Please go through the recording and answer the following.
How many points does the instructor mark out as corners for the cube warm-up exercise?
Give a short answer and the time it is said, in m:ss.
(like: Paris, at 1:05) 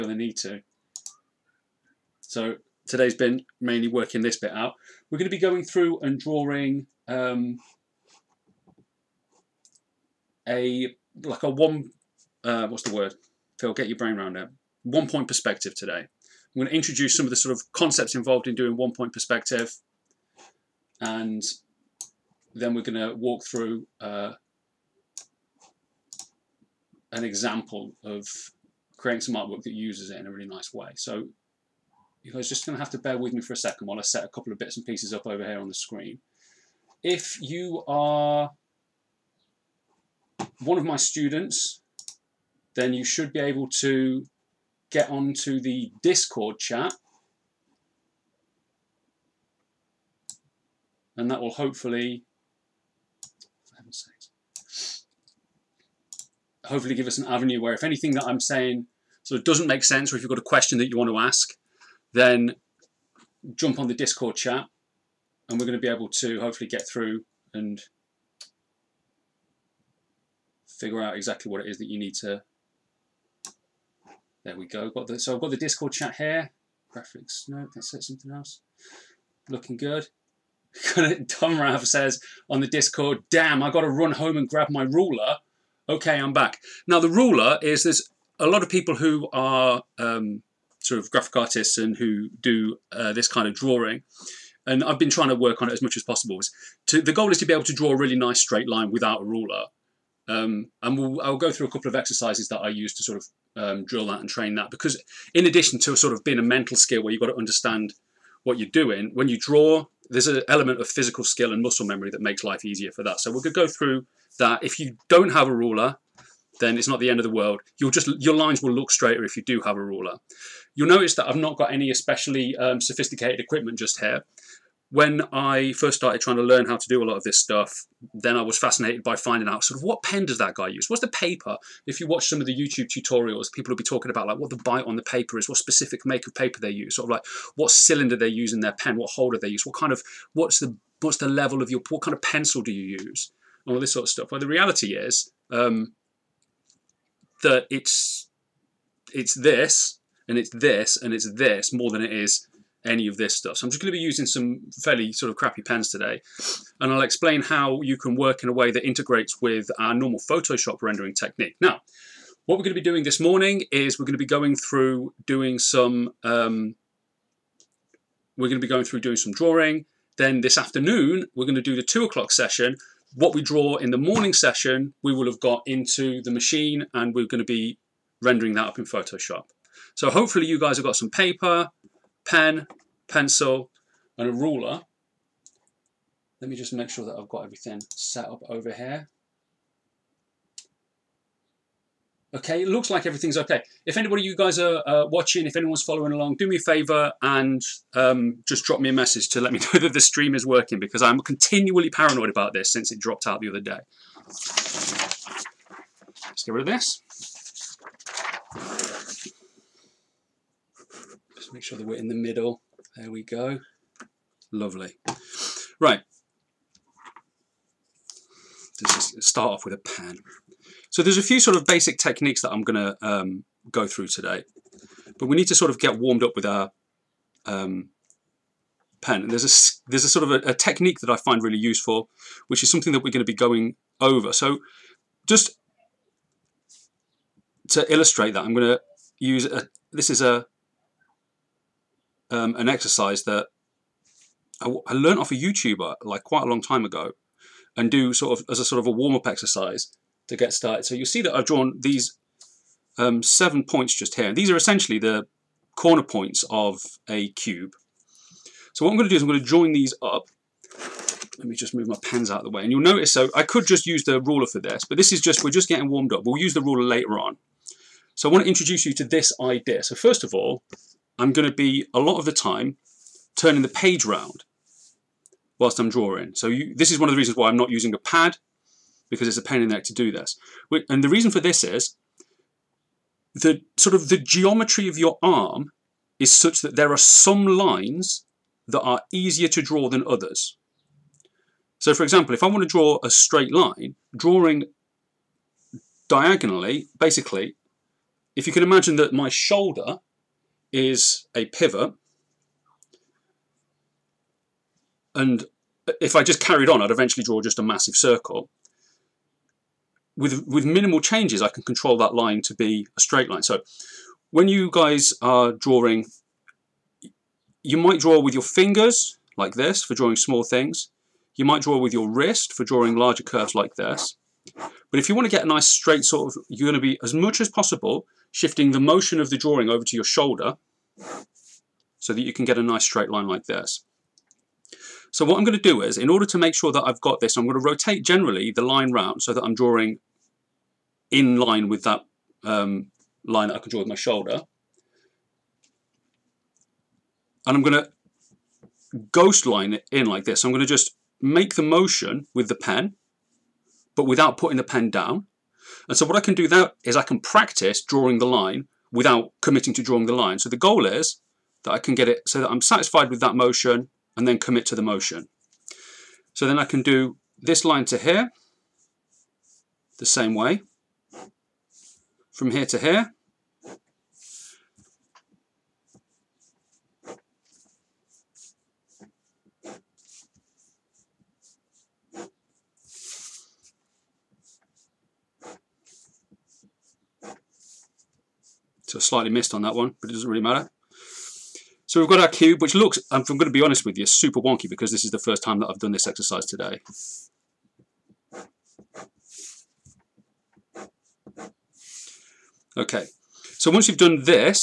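7, at 4:13.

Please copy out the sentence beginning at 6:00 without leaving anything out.
So the goal is that I can get it so that I'm satisfied with that motion and then commit to the motion.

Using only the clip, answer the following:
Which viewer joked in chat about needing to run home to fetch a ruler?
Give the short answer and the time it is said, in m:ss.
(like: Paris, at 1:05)
Tom Rav, at 1:21.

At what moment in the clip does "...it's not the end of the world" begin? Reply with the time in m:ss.
1:56.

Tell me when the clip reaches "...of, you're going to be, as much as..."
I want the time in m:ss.
5:26.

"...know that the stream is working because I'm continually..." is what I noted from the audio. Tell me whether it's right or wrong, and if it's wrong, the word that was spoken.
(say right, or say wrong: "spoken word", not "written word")
right.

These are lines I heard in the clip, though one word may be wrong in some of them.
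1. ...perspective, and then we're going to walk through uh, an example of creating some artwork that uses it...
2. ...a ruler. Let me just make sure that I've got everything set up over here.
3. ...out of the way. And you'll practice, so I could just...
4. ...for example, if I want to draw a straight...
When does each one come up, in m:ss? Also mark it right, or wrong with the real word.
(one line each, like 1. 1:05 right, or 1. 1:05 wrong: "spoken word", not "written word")
1. 0:19 right
2. 3:04 right
3. 4:22 wrong: "notice", not "practice"
4. 4:51 right.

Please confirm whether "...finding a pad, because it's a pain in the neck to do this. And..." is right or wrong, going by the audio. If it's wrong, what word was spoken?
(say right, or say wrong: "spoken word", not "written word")
wrong: "using", not "finding".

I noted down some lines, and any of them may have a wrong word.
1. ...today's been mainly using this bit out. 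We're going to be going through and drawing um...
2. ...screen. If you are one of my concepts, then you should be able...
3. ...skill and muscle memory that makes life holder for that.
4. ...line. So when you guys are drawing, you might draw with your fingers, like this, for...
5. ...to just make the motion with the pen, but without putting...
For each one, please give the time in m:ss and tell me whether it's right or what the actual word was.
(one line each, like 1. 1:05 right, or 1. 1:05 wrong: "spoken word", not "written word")
1. 0:02 wrong: "working", not "using"
2. 0:35 wrong: "students", not "concepts"
3. 1:51 wrong: "easier", not "holder"
4. 5:13 right
5. 5:50 right.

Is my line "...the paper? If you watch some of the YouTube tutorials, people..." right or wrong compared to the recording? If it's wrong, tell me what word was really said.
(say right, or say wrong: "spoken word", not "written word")
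right.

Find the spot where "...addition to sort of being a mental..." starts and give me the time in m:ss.
1:45.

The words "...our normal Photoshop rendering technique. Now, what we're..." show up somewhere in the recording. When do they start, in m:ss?
2:39.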